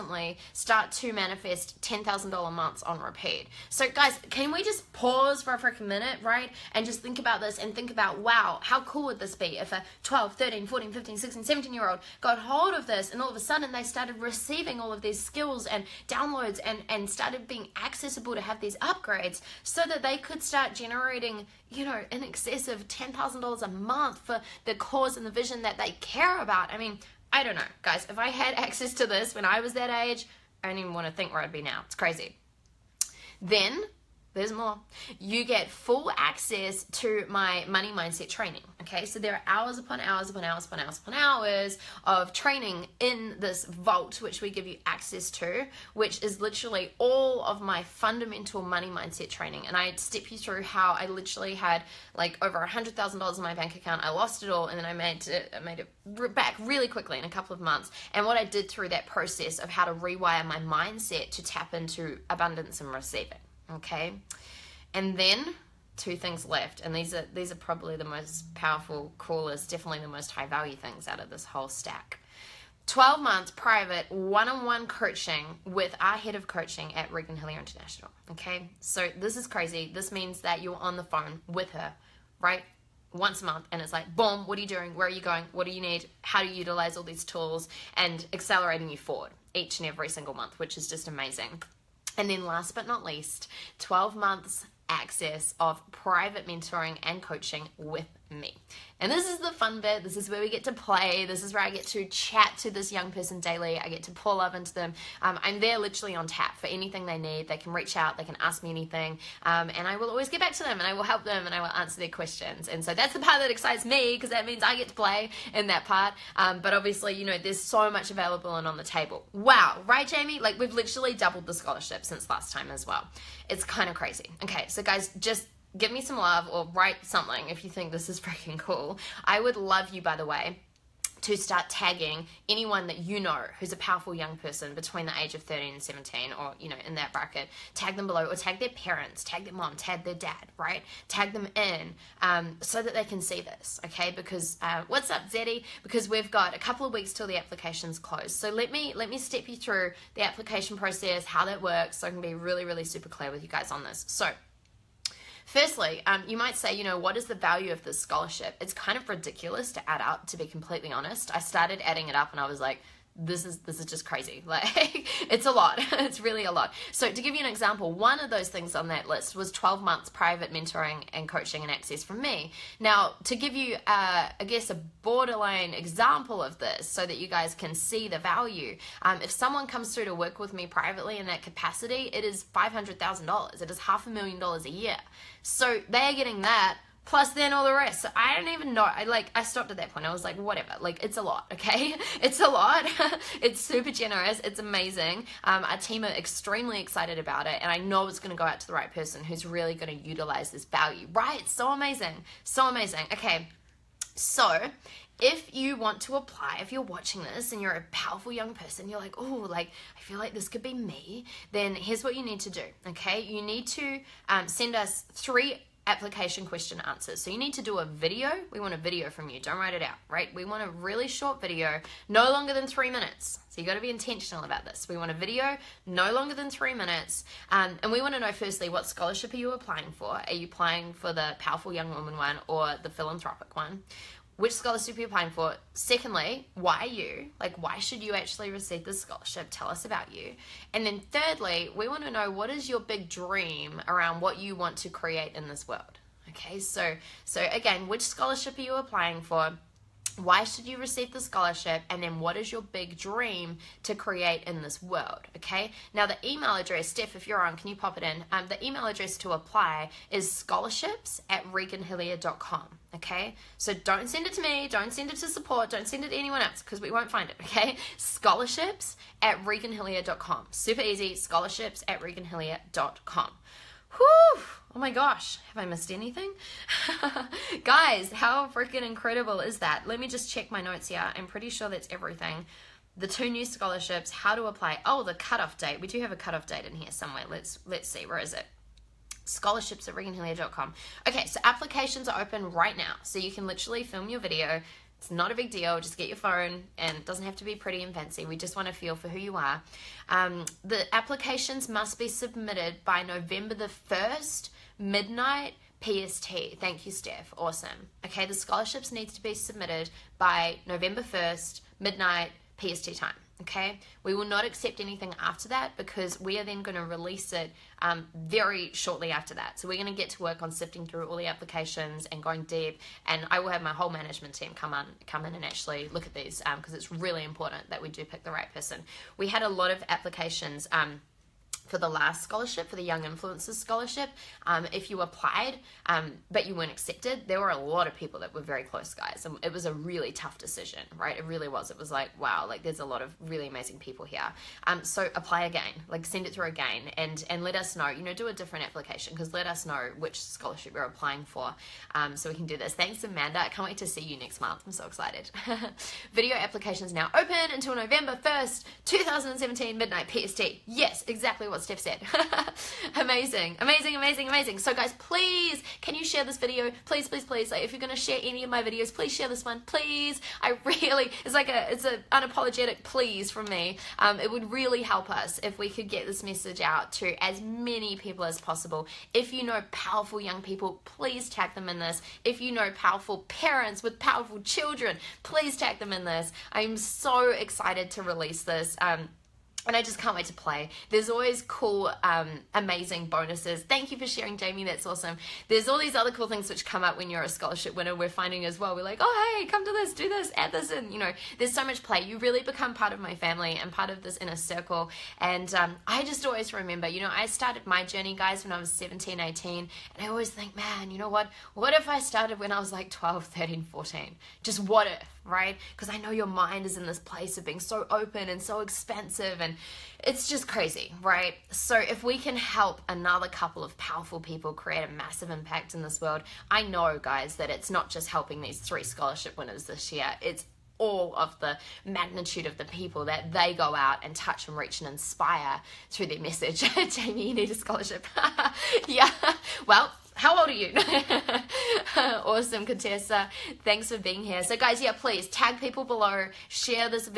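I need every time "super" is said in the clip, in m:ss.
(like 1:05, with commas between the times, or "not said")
2:32, 3:13, 4:30.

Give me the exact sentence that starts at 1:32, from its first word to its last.
And then last but not least, 12 months access of private mentoring and coaching with me.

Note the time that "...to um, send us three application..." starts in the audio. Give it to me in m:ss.
3:33.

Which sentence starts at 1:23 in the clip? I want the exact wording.
Once a month, and it's like, boom, what are you doing?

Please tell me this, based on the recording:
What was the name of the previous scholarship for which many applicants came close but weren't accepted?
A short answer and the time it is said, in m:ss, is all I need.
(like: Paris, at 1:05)
Young Influencers Scholarship, at 5:32.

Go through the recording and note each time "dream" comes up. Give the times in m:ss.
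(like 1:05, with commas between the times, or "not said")
4:03, 4:12.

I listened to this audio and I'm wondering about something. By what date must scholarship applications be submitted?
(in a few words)
November 1st.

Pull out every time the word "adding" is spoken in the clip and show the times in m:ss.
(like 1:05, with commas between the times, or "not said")
2:41.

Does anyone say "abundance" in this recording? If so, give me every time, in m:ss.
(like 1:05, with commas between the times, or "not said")
1:02.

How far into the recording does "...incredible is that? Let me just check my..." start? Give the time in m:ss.
4:38.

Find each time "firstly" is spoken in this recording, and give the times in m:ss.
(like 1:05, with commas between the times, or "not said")
2:35, 3:48.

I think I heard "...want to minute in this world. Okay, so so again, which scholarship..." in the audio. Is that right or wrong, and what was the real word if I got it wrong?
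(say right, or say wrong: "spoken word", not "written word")
wrong: "create", not "minute".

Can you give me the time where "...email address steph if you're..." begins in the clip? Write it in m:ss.
4:16.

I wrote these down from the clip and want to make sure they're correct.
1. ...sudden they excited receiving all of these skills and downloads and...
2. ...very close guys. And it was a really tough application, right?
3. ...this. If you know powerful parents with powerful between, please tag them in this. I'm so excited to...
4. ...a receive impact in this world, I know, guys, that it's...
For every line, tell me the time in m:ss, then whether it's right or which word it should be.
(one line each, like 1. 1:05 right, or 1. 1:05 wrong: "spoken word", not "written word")
1. 0:13 wrong: "started", not "excited"
2. 5:38 wrong: "decision", not "application"
3. 6:21 wrong: "children", not "between"
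4. 7:04 wrong: "massive", not "receive".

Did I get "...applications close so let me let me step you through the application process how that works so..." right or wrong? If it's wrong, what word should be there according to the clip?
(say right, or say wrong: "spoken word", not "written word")
right.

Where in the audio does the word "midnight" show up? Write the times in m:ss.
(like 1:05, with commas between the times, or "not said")
5:04, 5:11, 5:59.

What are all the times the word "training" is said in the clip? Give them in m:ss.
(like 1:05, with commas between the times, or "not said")
0:38, 0:42, 0:49.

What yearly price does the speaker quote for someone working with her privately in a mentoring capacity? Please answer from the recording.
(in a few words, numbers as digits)
$500,000.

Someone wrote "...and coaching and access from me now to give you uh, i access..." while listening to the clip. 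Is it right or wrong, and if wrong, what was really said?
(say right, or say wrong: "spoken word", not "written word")
wrong: "guess", not "access".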